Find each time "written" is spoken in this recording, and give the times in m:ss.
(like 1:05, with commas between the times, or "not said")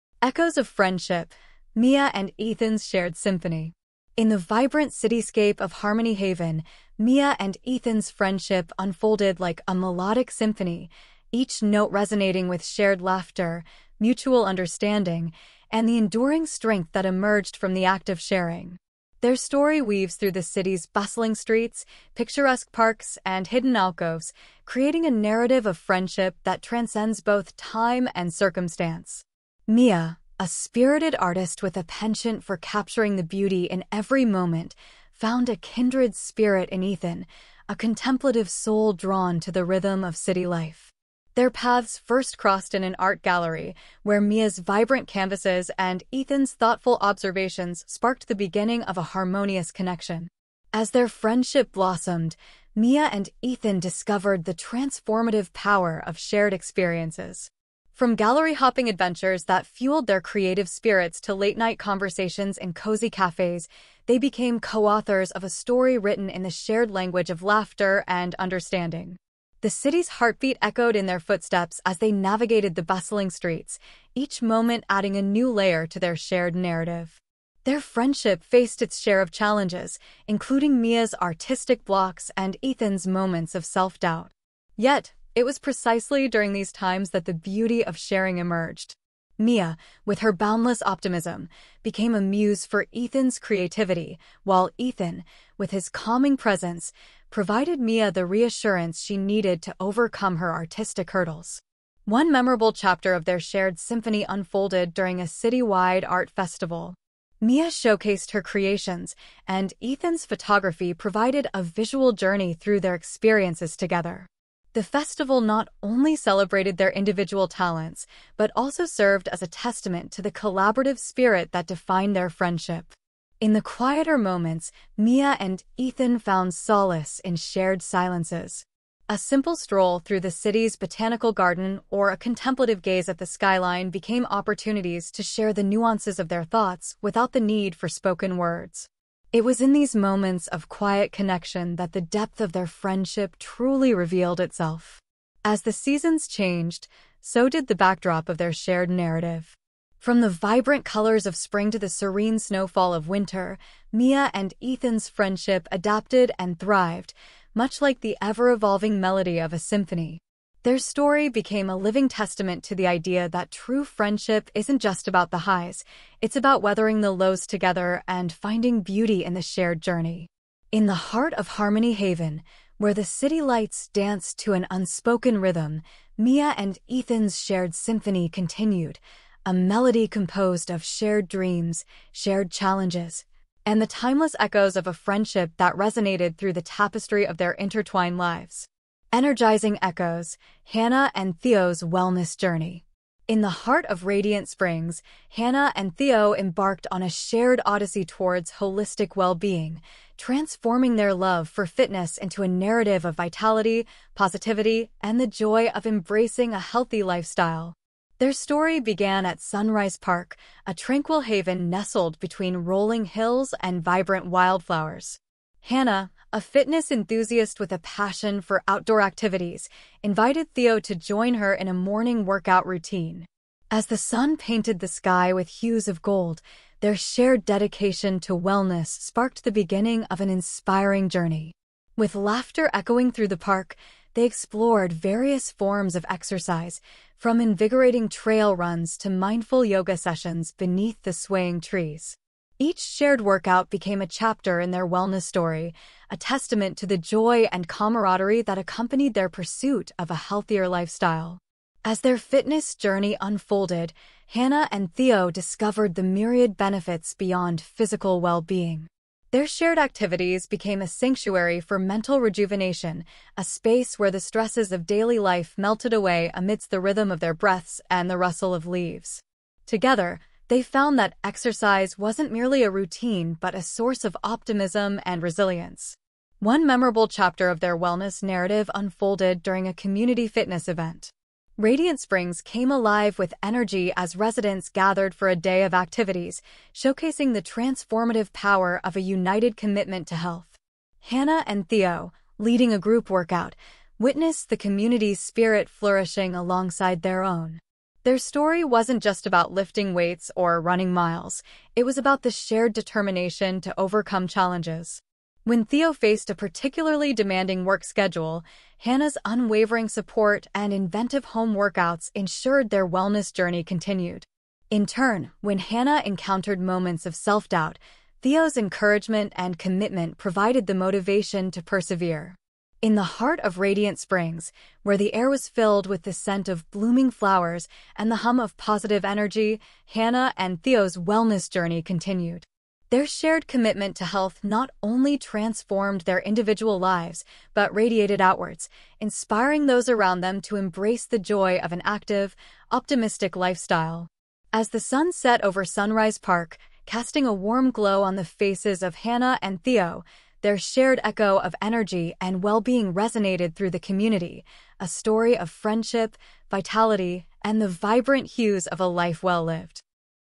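1:05.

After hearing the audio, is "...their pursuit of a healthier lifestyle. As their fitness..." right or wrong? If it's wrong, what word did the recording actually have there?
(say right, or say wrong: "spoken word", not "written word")
right.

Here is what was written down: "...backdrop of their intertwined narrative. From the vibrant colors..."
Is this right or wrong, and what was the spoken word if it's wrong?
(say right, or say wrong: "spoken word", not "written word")
wrong: "shared", not "intertwined".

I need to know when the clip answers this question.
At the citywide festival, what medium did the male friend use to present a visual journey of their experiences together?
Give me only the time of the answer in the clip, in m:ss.
1:50.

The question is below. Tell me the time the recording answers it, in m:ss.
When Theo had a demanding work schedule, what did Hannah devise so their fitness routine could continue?
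5:10.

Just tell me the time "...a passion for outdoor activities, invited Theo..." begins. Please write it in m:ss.
3:37.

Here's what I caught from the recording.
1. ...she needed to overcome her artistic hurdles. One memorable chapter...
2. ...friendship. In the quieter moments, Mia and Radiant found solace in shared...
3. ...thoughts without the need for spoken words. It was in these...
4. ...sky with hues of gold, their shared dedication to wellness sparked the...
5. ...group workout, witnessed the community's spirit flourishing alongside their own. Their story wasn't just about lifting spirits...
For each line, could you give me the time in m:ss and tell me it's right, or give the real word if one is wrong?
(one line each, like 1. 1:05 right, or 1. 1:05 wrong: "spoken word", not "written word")
1. 1:39 right
2. 2:02 wrong: "Ethan", not "Radiant"
3. 2:16 right
4. 3:44 right
5. 4:52 wrong: "weights", not "spirits".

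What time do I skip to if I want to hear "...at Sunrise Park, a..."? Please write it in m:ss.
3:29.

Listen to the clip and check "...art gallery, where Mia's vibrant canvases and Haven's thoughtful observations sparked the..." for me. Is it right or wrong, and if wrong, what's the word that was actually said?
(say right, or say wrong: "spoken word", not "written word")
wrong: "Ethan", not "Haven".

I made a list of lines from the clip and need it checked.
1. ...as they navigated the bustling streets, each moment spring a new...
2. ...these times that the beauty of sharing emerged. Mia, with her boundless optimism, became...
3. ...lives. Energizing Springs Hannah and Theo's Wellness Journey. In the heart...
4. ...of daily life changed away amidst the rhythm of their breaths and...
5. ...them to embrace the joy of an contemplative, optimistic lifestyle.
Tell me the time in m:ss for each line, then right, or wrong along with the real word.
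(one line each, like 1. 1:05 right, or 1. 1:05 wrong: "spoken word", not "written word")
1. 1:11 wrong: "adding", not "spring"
2. 1:26 right
3. 3:08 wrong: "Echoes", not "Springs"
4. 4:24 wrong: "melted", not "changed"
5. 5:40 wrong: "active", not "contemplative".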